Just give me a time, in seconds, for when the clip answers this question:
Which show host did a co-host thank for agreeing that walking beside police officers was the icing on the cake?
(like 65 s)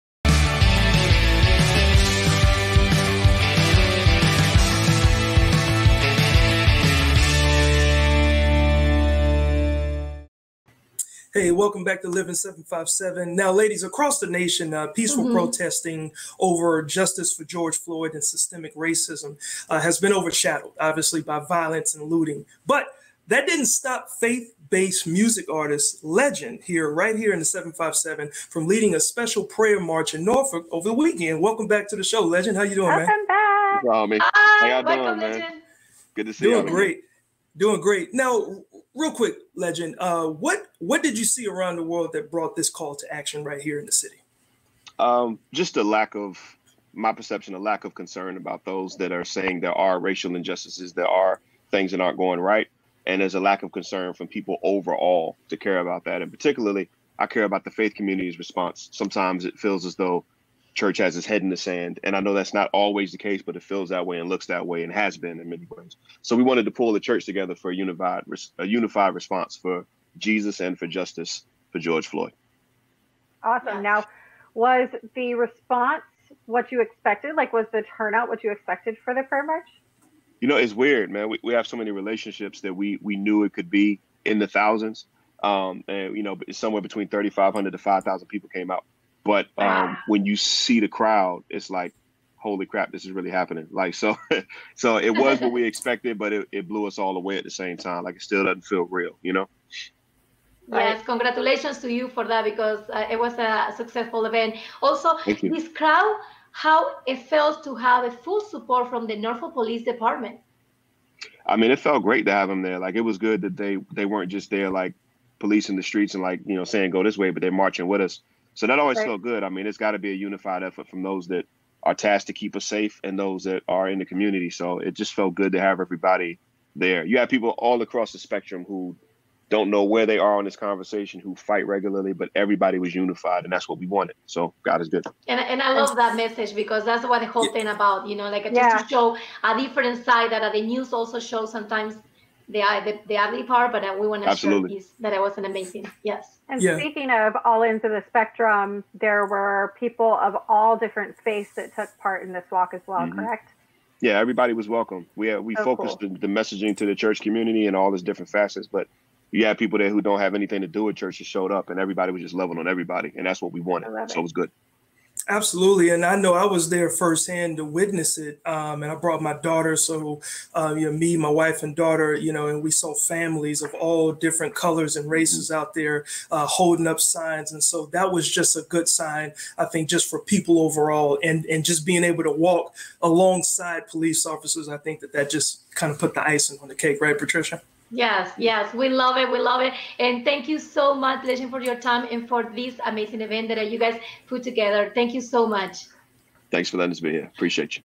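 187 s.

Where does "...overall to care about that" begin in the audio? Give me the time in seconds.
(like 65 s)
54 s.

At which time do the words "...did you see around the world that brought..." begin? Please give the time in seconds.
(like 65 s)
41 s.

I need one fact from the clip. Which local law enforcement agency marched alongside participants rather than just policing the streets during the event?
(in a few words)
Norfolk Police Department.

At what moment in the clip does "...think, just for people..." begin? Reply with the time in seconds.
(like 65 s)
179 s.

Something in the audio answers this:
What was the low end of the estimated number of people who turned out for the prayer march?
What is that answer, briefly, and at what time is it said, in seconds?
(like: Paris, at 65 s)
3,500, at 87 s.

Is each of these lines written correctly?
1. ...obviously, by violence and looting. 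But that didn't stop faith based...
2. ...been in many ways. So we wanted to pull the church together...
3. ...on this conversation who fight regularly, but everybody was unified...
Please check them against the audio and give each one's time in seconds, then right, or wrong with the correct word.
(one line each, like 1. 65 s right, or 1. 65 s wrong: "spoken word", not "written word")
1. 20 s right
2. 65 s right
3. 130 s right.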